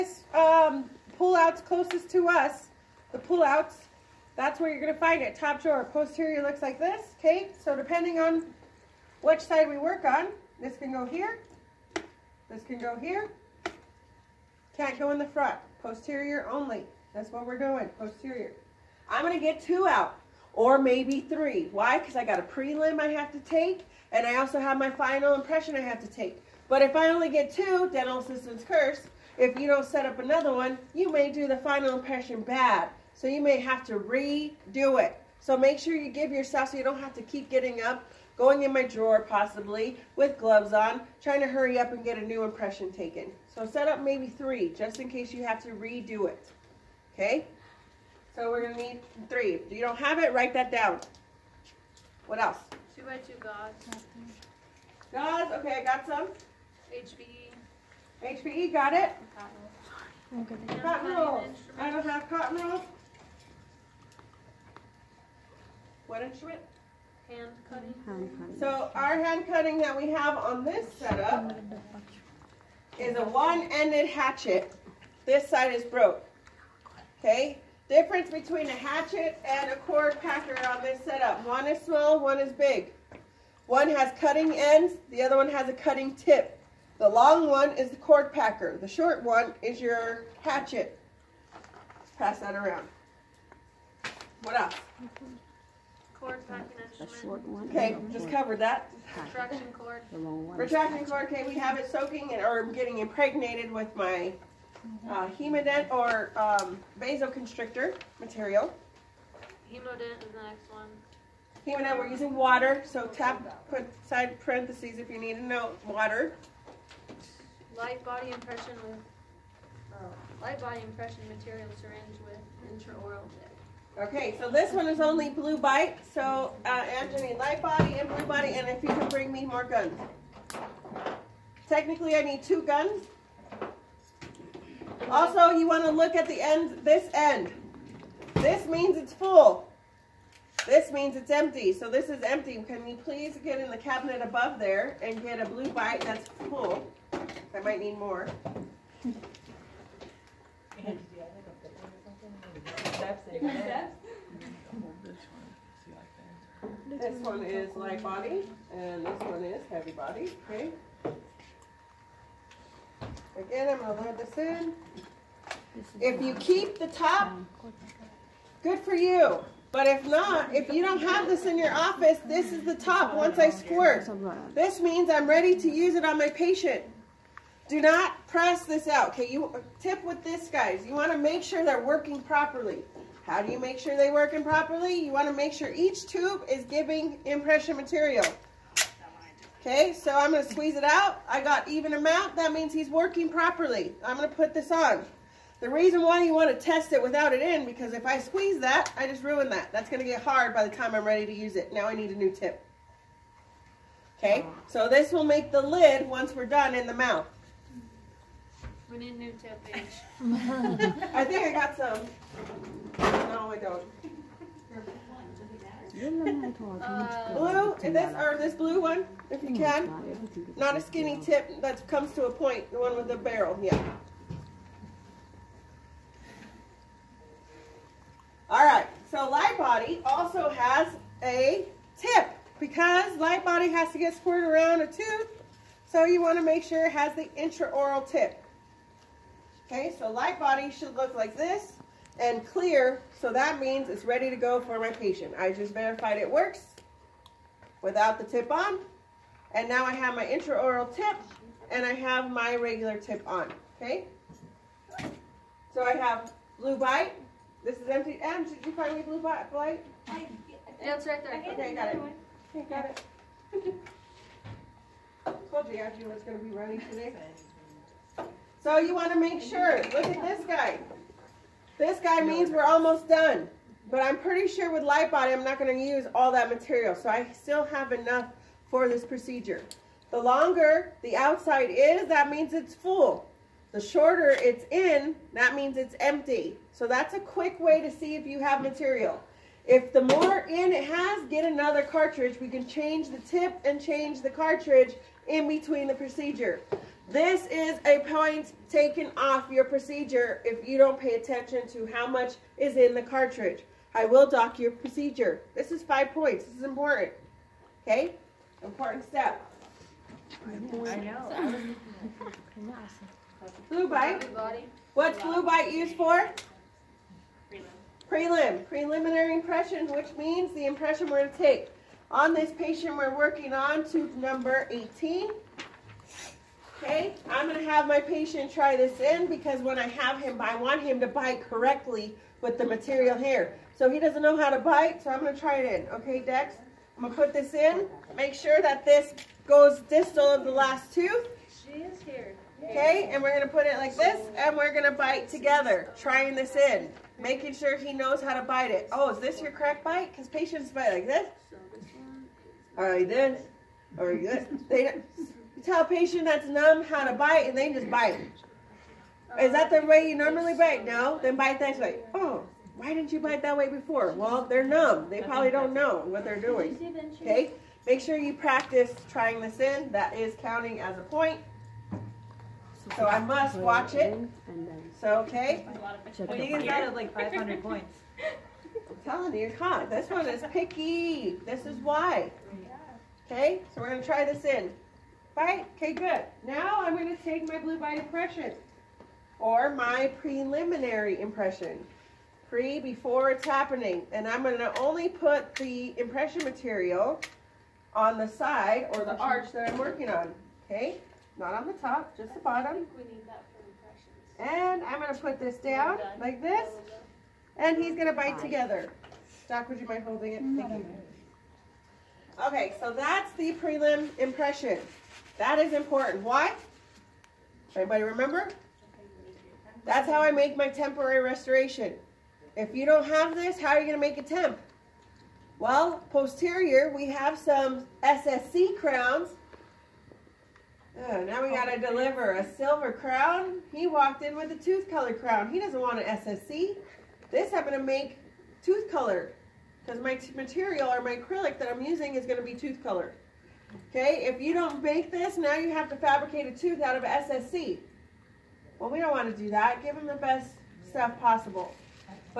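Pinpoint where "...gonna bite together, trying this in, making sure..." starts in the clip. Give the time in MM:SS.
05:44.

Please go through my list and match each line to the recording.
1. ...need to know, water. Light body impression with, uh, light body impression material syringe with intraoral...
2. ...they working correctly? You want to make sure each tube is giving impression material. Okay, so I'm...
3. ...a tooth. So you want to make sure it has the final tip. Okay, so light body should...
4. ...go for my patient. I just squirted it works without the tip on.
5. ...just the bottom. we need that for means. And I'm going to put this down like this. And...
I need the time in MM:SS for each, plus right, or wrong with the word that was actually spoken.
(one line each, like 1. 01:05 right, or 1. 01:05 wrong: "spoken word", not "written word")
1. 01:55 right
2. 03:03 wrong: "properly", not "correctly"
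3. 03:54 wrong: "intraoral", not "final"
4. 04:04 wrong: "verified", not "squirted"
5. 06:42 wrong: "impressions", not "means".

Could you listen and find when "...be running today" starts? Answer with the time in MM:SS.
04:26.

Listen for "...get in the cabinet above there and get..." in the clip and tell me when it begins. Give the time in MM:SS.
02:23.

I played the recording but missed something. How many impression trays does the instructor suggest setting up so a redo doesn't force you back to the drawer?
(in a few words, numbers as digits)
3.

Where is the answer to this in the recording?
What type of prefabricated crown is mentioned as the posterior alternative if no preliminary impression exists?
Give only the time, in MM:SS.
07:08.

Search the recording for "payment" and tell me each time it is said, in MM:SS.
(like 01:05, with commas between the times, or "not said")
not said.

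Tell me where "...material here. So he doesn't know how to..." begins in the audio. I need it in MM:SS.
05:32.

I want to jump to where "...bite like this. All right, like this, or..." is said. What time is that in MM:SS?
05:50.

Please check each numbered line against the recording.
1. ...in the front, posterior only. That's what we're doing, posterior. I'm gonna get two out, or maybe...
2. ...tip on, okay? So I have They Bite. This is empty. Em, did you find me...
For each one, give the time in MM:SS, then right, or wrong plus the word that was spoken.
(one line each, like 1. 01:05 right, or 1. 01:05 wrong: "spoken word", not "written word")
1. 00:15 right
2. 04:12 wrong: "Blue", not "They".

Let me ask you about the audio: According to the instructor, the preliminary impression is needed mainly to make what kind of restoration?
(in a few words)
temporary restoration.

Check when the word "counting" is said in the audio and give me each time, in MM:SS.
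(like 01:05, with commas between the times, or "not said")
06:10.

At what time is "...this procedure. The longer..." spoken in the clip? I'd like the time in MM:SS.
04:38.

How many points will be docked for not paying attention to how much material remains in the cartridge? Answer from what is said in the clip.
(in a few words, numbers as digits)
5.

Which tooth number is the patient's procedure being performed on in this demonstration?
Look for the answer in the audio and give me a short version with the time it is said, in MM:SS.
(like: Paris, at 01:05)
18, at 05:23.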